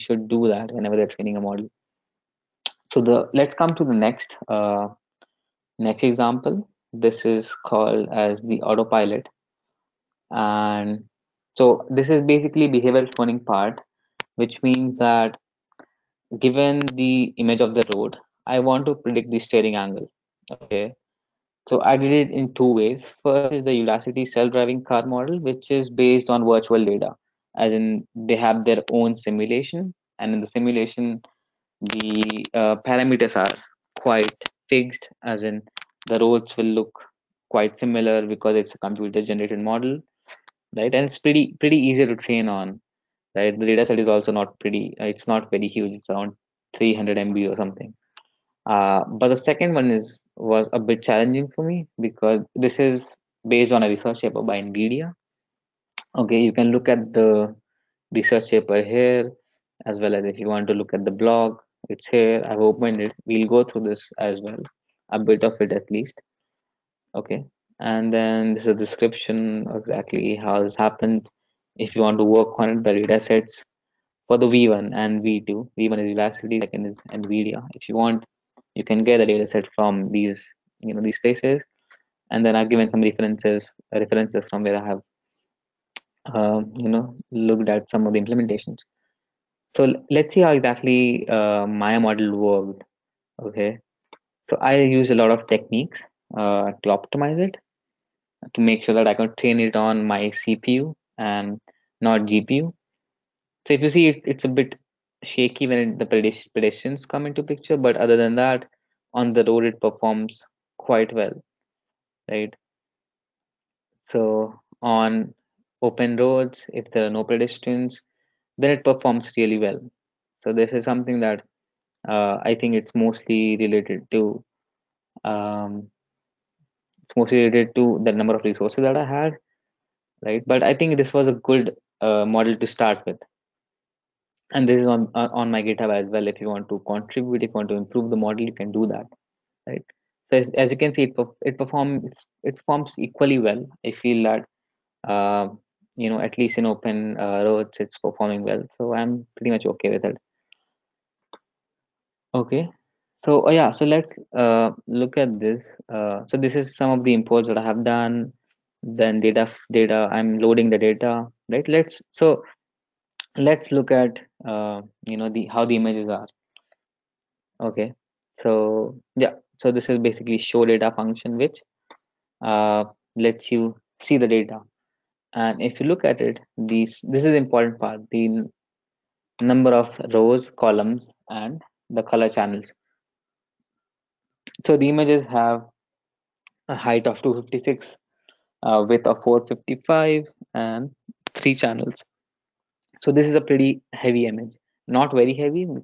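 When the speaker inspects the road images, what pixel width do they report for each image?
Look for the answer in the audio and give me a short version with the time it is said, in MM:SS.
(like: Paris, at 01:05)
455, at 03:09.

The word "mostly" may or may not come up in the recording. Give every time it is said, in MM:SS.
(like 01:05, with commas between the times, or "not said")
02:02, 02:07.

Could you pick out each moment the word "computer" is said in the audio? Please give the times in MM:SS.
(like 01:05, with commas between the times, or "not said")
00:38.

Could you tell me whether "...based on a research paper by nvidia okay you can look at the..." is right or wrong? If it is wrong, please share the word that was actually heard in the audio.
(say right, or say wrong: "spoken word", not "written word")
right.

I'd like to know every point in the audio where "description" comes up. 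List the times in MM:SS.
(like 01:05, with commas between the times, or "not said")
01:08.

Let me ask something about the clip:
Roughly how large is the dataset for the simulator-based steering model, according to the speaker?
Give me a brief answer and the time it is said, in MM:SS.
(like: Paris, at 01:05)
300 MB, at 00:46.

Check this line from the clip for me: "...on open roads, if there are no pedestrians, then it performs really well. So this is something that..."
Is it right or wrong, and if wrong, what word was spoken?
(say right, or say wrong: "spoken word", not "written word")
right.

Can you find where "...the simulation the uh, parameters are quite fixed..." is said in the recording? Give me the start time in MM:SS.
00:30.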